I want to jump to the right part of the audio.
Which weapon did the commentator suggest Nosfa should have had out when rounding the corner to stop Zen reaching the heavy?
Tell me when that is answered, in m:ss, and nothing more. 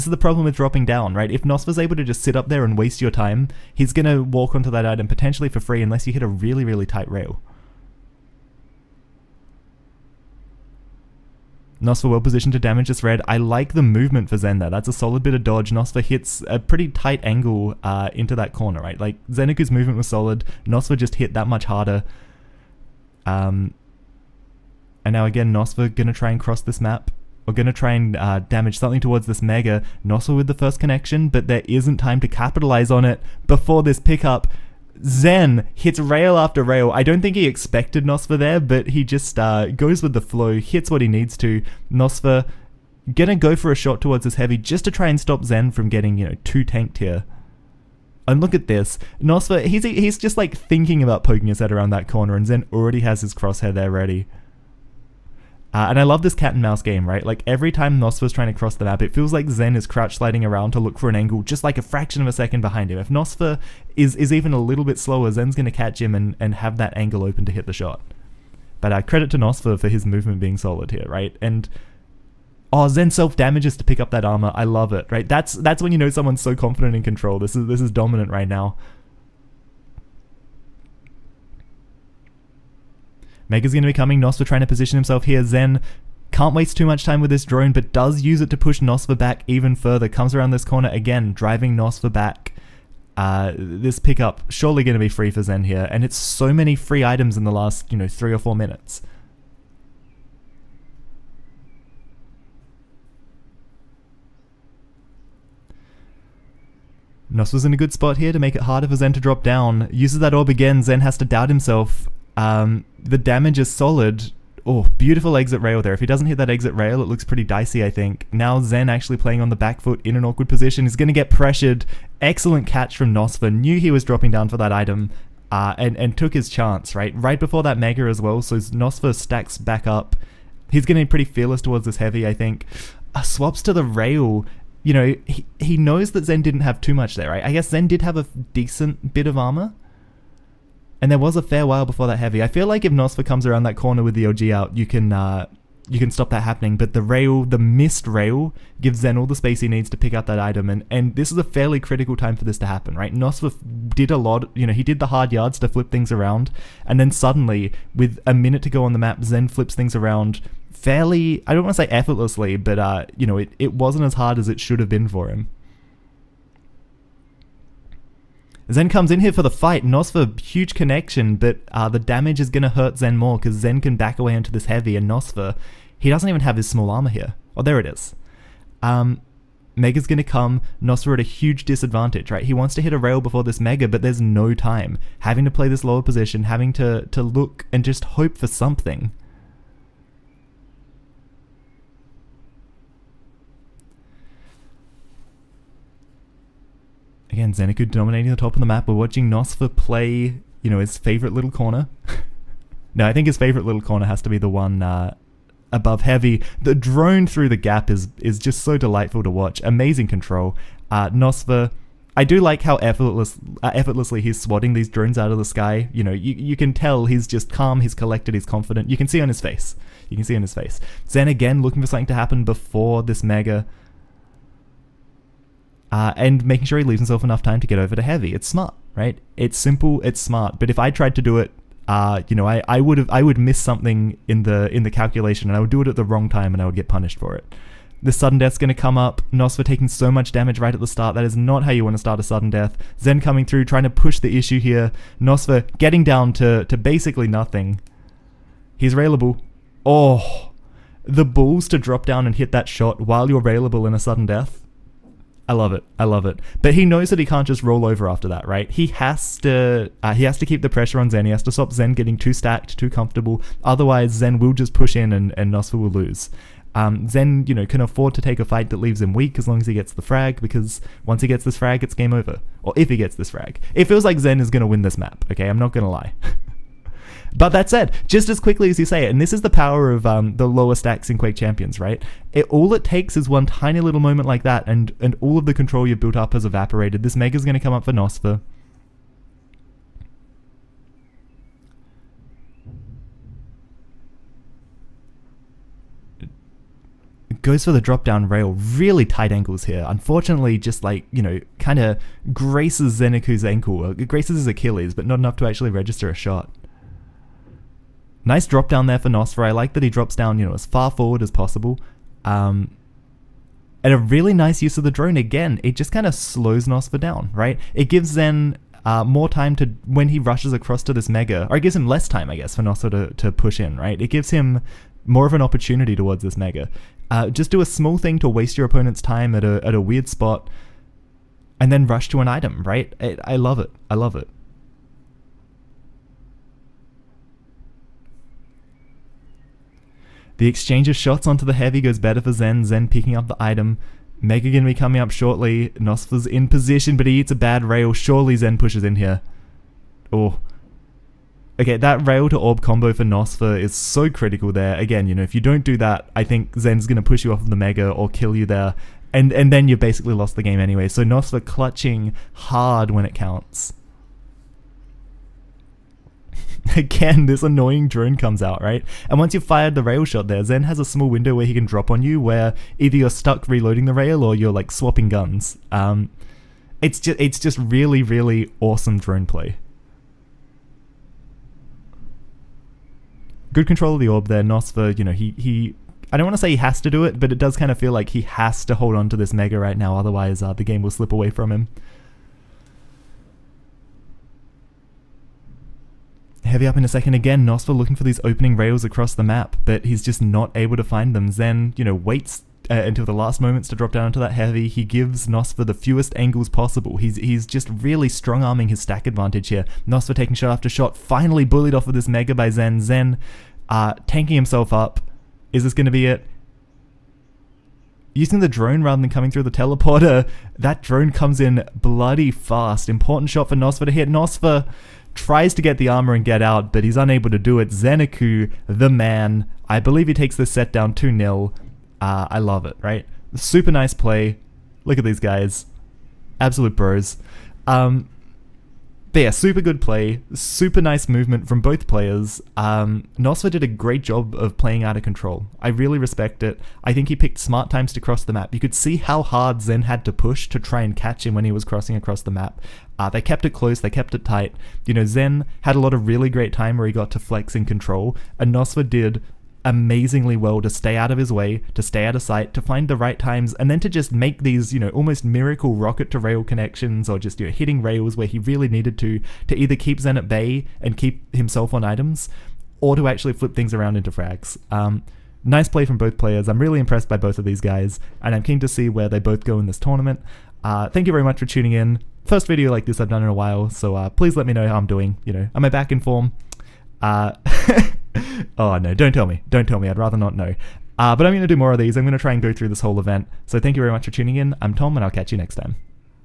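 2:24.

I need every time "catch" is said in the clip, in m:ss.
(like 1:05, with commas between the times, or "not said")
1:05, 2:02, 7:30, 8:15.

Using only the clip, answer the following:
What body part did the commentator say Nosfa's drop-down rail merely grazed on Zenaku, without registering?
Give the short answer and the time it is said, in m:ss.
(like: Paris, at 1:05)
Achilles, at 5:03.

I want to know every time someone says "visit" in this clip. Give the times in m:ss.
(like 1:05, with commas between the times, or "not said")
not said.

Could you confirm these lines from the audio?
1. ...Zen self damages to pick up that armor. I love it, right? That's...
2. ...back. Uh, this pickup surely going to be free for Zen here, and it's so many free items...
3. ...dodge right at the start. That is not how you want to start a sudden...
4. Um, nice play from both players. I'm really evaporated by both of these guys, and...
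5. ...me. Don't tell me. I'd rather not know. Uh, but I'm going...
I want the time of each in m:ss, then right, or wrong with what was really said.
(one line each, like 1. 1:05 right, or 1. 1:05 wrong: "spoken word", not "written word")
1. 1:12 right
2. 1:32 right
3. 4:00 wrong: "damage", not "dodge"
4. 7:54 wrong: "impressed", not "evaporated"
5. 8:09 right.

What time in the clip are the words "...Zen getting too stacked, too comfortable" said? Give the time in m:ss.
4:21.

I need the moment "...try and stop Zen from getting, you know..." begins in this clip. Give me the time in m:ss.
0:44.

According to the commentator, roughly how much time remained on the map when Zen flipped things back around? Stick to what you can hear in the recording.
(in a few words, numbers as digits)
a minute.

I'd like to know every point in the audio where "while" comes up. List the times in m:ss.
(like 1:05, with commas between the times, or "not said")
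2:21, 4:13, 8:03.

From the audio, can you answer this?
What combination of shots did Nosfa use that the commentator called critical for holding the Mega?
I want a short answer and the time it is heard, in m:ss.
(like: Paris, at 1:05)
rail to orb combo, at 5:52.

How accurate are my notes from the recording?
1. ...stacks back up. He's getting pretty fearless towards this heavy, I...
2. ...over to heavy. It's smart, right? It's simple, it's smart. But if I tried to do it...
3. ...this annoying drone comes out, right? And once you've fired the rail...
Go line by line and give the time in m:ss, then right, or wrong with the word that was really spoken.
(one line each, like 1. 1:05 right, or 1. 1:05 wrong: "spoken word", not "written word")
1. 2:09 right
2. 3:47 right
3. 6:07 right.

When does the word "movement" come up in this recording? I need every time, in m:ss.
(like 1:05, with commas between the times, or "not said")
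0:13, 0:19, 1:10, 7:21.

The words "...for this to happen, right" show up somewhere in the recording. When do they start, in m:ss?
2:32.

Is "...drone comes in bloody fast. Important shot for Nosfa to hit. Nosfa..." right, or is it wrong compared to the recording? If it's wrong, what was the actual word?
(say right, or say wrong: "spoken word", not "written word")
right.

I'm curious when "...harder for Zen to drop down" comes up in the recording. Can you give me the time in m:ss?
1:48.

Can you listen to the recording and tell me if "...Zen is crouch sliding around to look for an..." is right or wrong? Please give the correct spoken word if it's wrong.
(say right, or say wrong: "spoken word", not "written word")
right.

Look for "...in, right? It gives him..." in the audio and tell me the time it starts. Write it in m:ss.
5:23.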